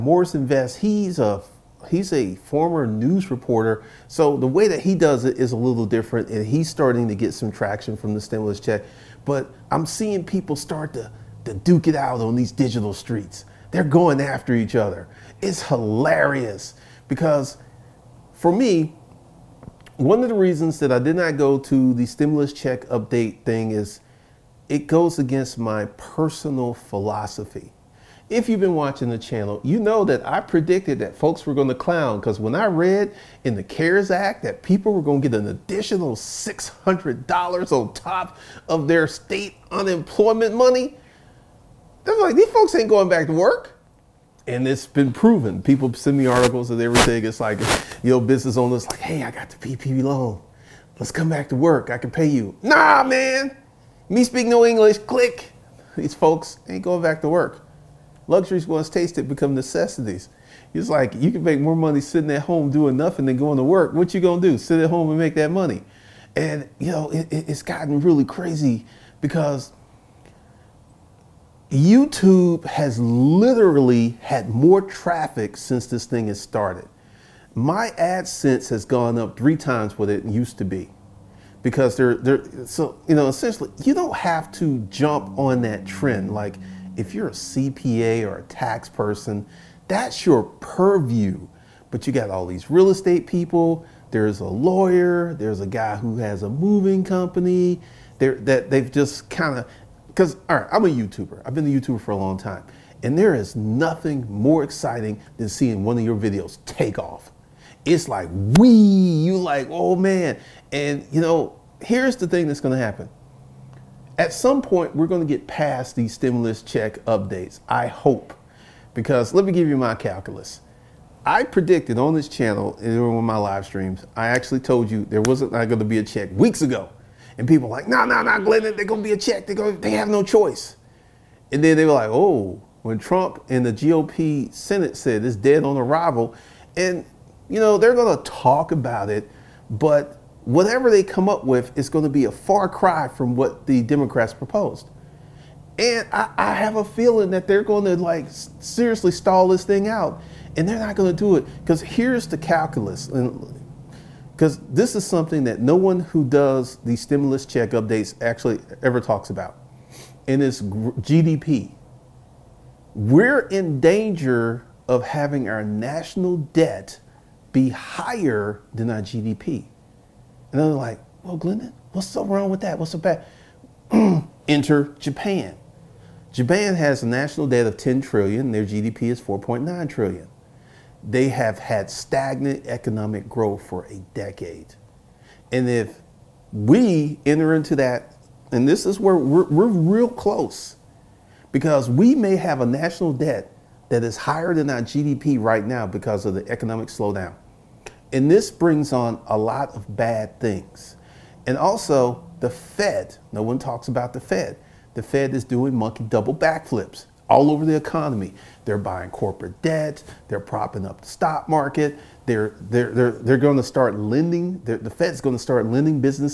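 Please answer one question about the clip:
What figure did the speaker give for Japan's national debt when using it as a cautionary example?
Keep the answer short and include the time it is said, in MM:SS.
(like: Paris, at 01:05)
10 trillion, at 02:57.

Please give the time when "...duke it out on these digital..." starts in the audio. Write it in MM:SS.
00:11.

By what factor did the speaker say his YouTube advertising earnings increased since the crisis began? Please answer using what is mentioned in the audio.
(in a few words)
3 times.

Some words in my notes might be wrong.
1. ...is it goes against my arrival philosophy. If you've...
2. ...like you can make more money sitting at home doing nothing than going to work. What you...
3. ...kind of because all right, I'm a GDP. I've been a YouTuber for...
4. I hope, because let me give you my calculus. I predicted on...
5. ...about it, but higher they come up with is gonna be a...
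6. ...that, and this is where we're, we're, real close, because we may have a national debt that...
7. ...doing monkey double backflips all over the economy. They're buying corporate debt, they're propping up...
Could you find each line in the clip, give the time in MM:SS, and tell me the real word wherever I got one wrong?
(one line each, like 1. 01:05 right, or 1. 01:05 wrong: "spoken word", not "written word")
1. 00:23 wrong: "personal", not "arrival"
2. 01:00 right
3. 01:39 wrong: "YouTuber", not "GDP"
4. 01:57 right
5. 02:18 wrong: "whatever", not "higher"
6. 03:07 right
7. 03:25 right.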